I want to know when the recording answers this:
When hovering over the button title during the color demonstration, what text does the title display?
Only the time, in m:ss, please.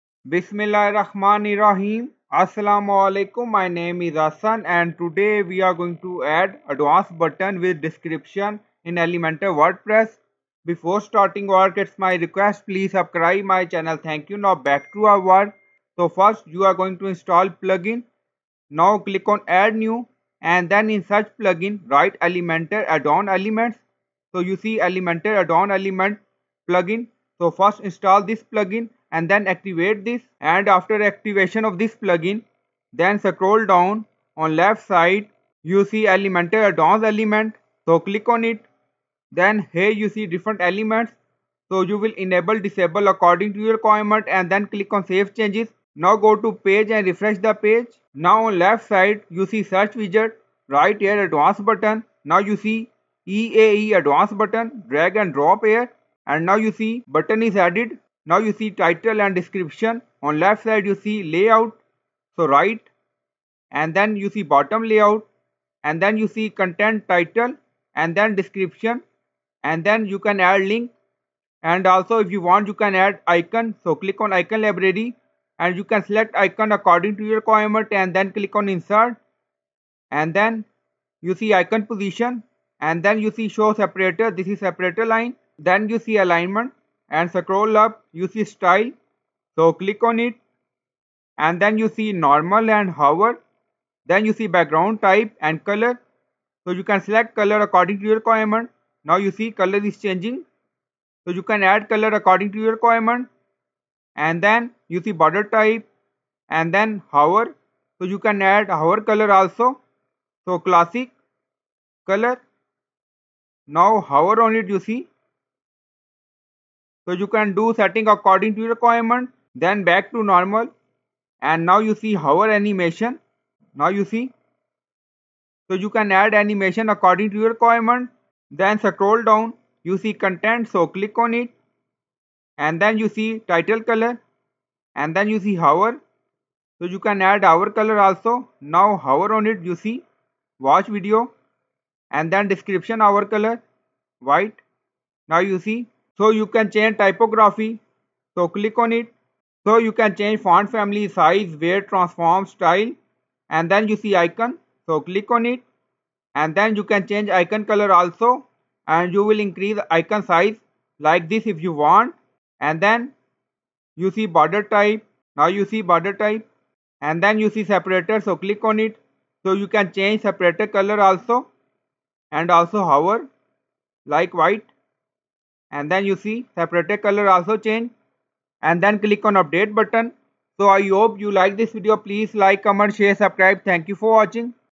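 2:20.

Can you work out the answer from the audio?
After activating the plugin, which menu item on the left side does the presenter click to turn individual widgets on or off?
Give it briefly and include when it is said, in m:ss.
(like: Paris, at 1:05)
Elementor advanced element, at 0:36.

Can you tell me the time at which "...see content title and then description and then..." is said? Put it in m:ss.
1:06.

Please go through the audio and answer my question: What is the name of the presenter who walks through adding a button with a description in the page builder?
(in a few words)
Hassan.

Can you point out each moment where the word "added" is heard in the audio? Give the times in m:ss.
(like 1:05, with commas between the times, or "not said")
0:57.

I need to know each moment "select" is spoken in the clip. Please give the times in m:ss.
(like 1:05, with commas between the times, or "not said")
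1:16, 1:37.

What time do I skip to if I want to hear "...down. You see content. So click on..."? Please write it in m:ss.
2:09.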